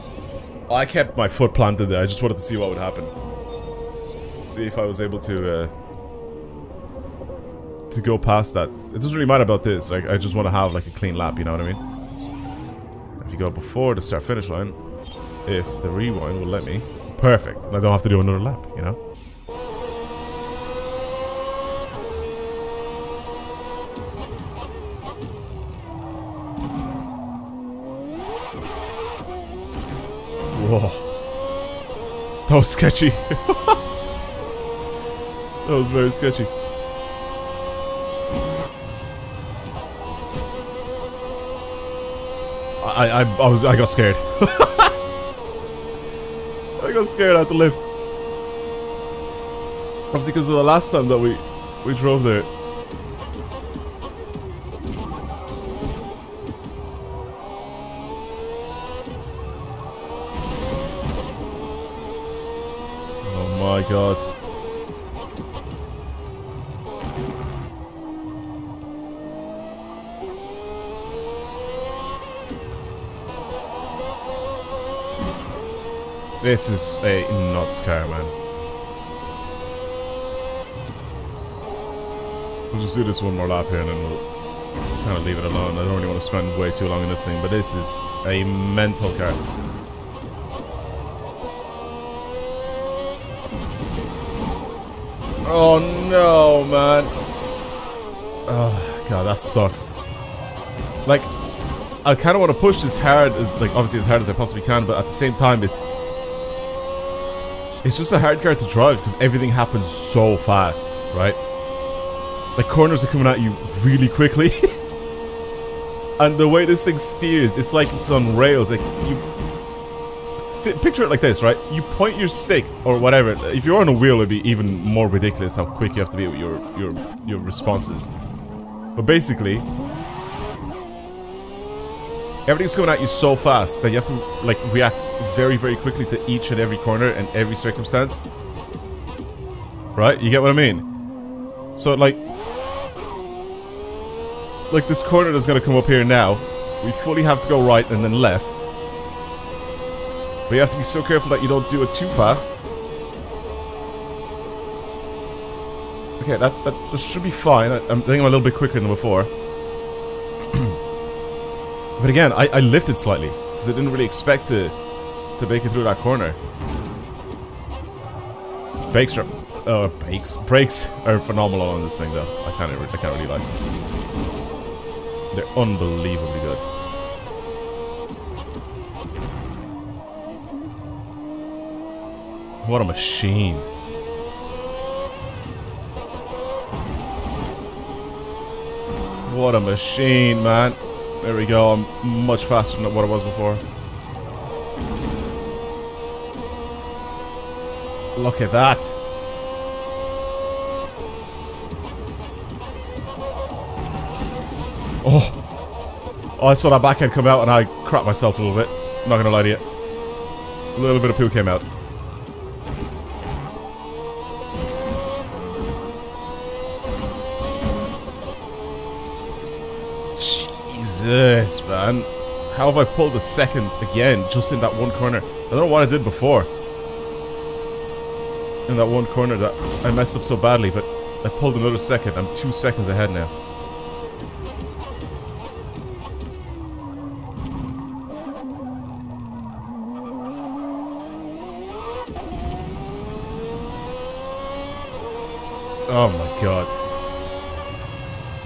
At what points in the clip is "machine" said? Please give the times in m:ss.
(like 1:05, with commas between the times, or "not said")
3:02, 3:09.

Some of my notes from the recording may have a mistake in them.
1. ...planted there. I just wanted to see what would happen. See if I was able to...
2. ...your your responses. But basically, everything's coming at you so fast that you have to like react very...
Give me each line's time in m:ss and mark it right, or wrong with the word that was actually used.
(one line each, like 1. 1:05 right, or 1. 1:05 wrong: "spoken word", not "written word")
1. 0:01 right
2. 2:06 right.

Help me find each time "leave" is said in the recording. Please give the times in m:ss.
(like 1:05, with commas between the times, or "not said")
1:25.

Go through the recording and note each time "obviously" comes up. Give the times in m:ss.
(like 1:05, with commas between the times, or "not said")
0:50, 1:43.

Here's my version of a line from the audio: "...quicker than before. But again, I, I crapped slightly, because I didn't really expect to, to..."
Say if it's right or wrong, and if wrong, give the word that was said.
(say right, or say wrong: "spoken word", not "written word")
wrong: "lifted", not "crapped".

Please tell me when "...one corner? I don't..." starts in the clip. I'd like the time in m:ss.
3:44.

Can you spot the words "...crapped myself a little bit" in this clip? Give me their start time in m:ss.
3:27.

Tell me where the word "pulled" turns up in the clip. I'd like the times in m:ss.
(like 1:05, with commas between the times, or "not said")
3:42, 3:51.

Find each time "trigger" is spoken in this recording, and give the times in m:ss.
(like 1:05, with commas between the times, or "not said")
not said.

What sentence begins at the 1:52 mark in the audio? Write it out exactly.
The corners are coming at you really quickly.